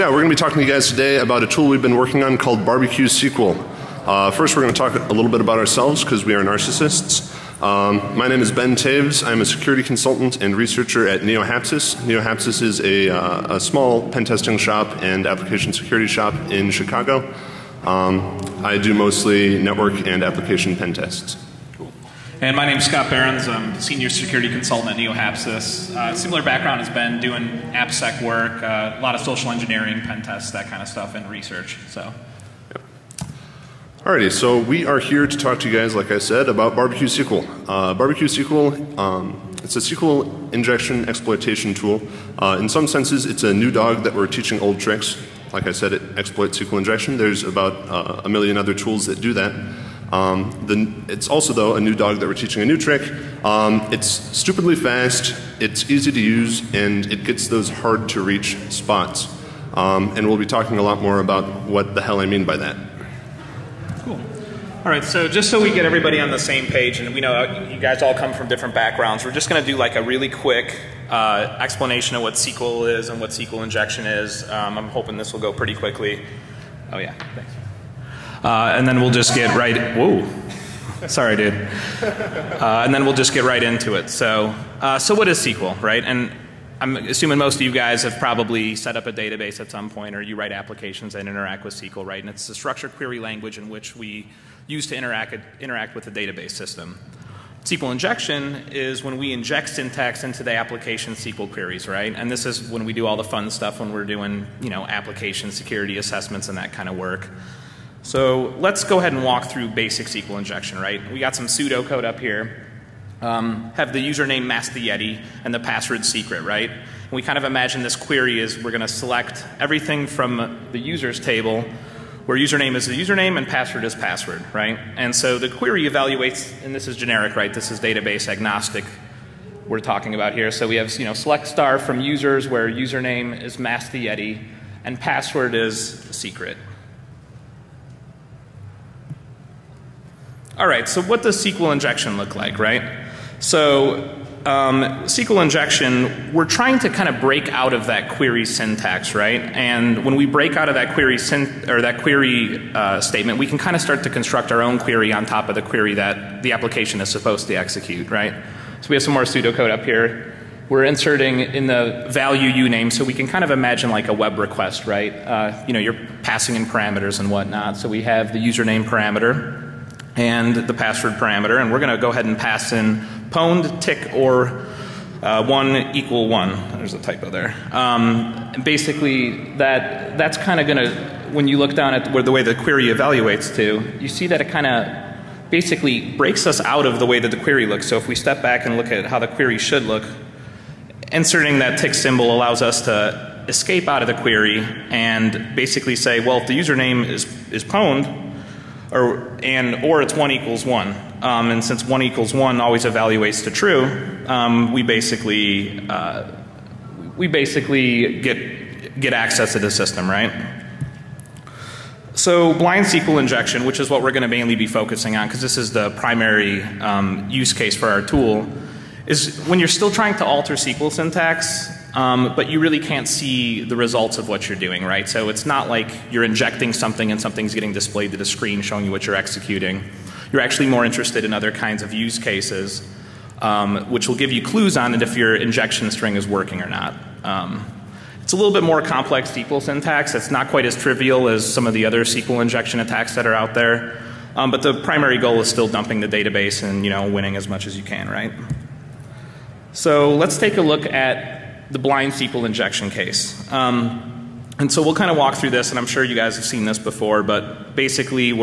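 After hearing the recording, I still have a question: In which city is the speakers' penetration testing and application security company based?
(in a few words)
Chicago.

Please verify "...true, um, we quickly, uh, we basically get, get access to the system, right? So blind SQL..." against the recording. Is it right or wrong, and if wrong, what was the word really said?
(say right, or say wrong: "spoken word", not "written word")
wrong: "basically", not "quickly".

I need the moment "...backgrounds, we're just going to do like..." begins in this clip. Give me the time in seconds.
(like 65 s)
68 s.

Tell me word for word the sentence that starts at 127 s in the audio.
This is database agnostic we're talking about here.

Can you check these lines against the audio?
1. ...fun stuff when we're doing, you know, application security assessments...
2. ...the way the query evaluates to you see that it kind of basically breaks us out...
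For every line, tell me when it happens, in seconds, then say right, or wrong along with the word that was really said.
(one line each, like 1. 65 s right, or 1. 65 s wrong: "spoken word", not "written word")
1. 103 s right
2. 182 s right.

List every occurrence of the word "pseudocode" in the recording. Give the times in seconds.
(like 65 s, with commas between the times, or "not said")
111 s, 159 s.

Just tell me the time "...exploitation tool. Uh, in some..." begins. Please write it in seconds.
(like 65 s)
41 s.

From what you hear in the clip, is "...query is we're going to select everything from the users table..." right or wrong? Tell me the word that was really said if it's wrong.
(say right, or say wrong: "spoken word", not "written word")
right.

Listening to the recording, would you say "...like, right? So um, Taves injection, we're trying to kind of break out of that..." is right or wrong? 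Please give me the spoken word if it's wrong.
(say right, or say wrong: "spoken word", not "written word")
wrong: "SQL", not "Taves".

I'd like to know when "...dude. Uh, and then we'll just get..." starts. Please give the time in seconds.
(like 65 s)
81 s.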